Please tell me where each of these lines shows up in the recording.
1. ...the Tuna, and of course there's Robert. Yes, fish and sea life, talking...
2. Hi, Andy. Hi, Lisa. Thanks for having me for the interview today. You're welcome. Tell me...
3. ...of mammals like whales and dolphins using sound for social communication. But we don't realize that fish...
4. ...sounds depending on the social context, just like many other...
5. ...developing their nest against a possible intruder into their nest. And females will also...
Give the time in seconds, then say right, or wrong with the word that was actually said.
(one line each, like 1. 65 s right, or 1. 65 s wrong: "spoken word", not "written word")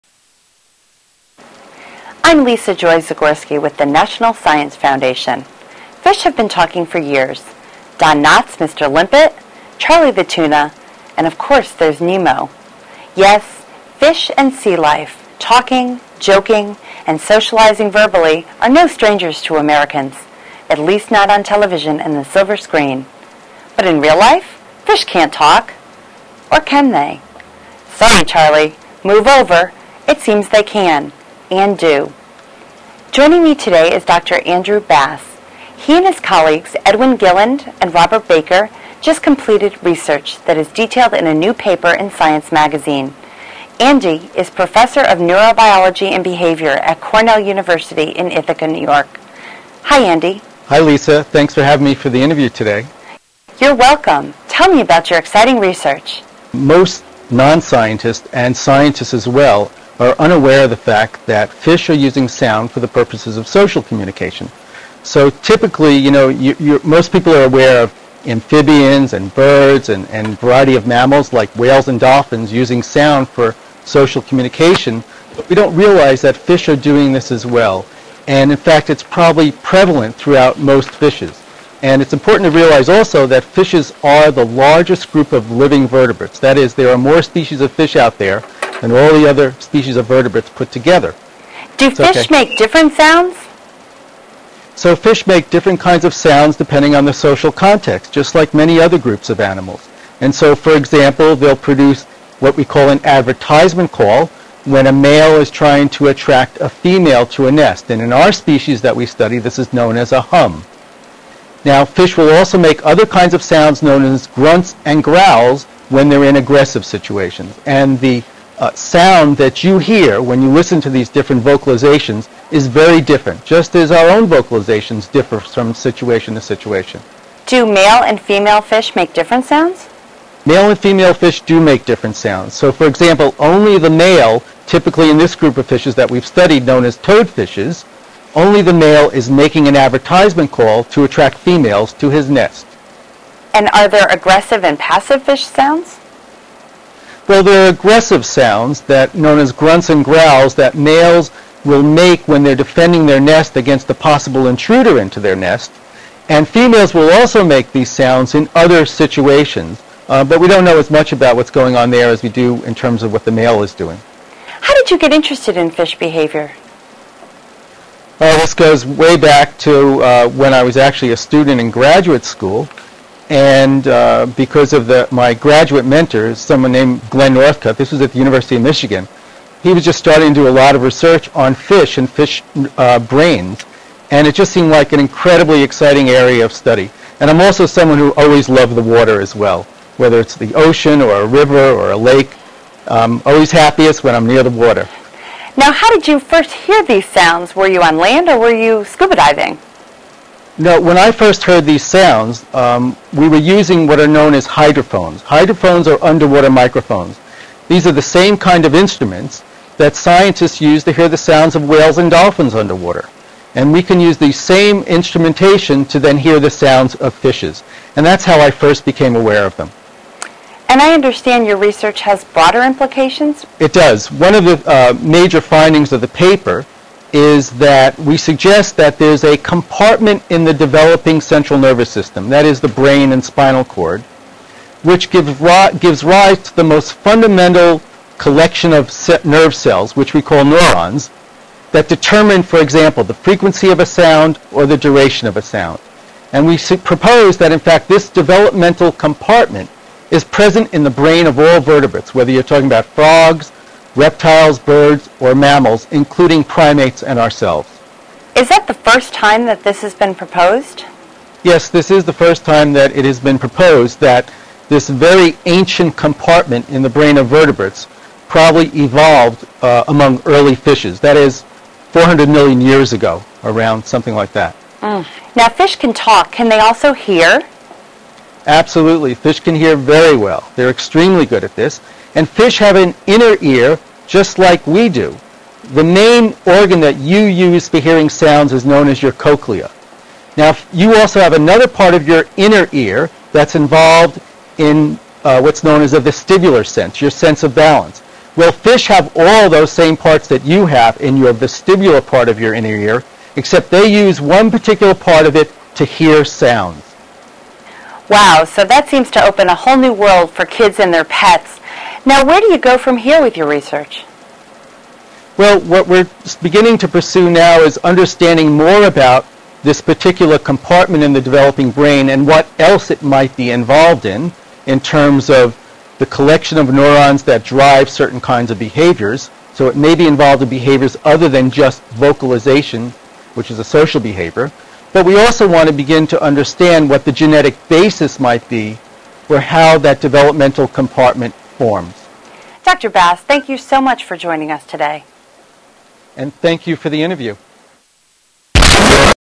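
1. 10 s wrong: "Nemo", not "Robert"
2. 49 s right
3. 70 s right
4. 96 s right
5. 152 s wrong: "defending", not "developing".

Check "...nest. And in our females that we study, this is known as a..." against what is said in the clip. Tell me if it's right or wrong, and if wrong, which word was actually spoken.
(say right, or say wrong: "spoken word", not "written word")
wrong: "species", not "females".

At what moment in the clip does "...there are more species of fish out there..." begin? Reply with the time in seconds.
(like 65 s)
86 s.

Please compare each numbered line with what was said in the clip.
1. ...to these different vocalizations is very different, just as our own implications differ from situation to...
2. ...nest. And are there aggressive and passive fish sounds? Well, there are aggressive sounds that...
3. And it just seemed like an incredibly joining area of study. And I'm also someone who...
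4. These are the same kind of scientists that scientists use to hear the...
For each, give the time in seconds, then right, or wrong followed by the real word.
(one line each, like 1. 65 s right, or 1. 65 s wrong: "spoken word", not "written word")
1. 120 s wrong: "vocalizations", not "implications"
2. 142 s right
3. 184 s wrong: "exciting", not "joining"
4. 207 s wrong: "instruments", not "scientists".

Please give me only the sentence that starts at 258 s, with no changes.
Is that the first time that this has been proposed?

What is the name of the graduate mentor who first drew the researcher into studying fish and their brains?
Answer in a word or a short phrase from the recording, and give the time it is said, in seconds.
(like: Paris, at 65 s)
Glenn Northcutt, at 177 s.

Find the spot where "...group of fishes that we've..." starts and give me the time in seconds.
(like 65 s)
135 s.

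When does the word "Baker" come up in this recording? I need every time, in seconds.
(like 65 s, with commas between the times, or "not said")
38 s.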